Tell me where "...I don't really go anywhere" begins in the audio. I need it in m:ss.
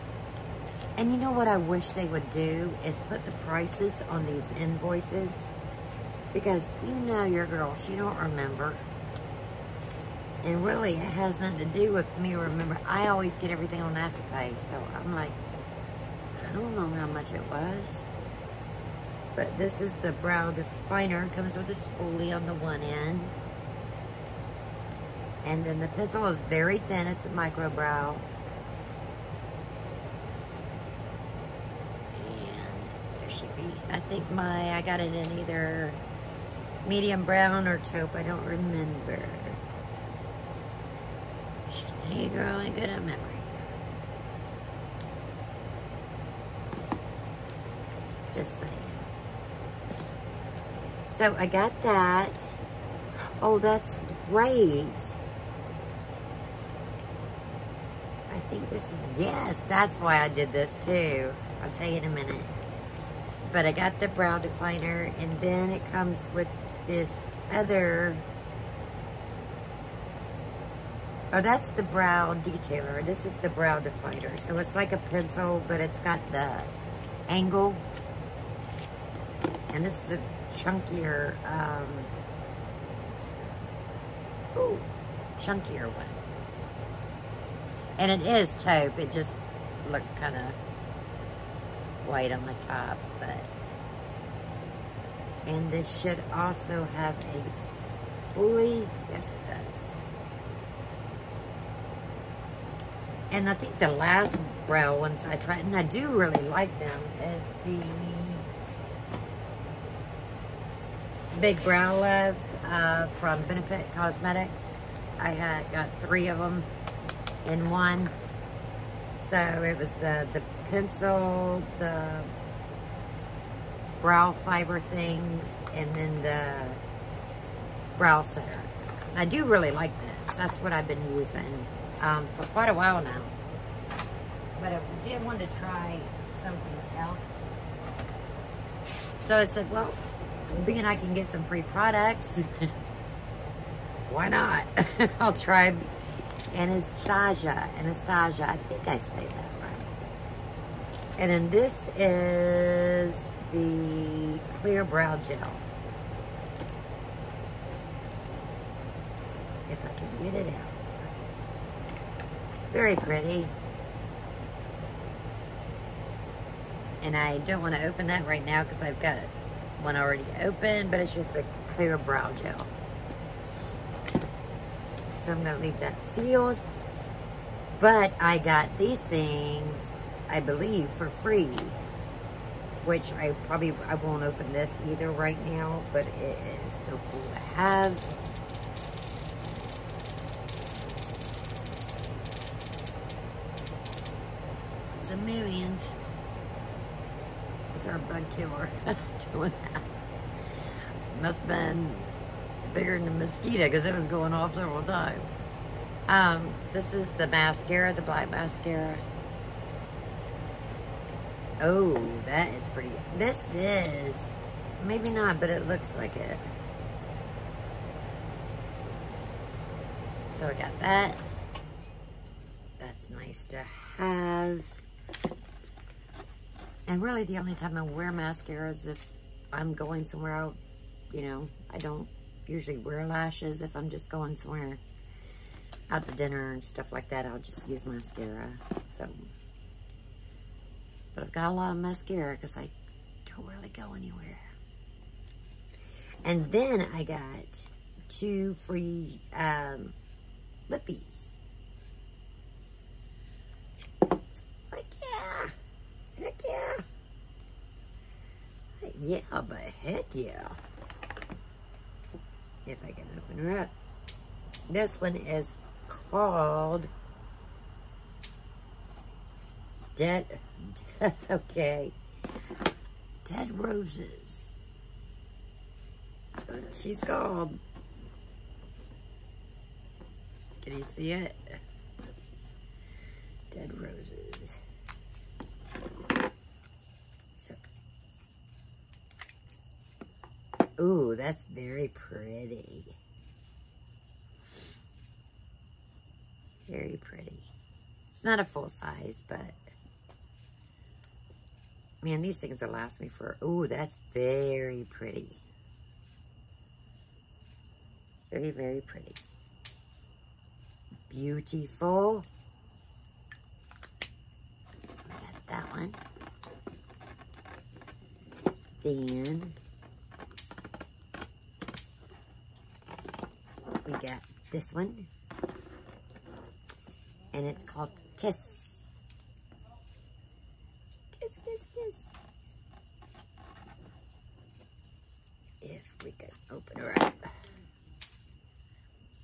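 4:02.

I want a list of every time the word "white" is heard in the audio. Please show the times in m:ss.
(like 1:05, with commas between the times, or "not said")
1:32.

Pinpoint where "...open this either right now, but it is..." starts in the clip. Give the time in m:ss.
3:04.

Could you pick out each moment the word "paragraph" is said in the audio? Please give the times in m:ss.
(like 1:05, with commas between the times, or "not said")
not said.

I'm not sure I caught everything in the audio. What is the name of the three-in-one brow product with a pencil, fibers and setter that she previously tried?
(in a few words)
Big Brow Love.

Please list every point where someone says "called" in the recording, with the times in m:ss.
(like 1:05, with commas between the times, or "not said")
4:25, 4:37, 5:27.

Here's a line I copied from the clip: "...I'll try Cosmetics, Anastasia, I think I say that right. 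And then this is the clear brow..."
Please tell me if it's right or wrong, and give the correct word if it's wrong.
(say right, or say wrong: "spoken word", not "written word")
wrong: "Anastasia", not "Cosmetics".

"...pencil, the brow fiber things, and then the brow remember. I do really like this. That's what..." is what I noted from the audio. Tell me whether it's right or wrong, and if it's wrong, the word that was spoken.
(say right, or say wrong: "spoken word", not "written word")
wrong: "setter", not "remember".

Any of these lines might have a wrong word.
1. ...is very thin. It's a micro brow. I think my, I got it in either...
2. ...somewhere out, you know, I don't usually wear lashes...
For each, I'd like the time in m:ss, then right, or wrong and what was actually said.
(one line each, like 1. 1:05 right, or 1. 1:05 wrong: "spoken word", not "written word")
1. 0:26 right
2. 3:50 right.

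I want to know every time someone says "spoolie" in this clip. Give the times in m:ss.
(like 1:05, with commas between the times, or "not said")
0:21, 1:37.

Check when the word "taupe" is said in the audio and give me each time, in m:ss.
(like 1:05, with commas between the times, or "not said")
0:37, 1:28.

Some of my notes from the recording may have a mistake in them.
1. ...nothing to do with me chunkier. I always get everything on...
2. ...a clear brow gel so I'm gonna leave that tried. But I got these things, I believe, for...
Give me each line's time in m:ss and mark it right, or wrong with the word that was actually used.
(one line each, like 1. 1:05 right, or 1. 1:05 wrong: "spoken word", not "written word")
1. 0:11 wrong: "remember", not "chunkier"
2. 2:51 wrong: "sealed", not "tried".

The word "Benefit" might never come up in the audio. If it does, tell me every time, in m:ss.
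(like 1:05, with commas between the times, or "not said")
1:53.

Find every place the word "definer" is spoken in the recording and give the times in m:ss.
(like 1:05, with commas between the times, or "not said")
0:20, 1:04, 1:13.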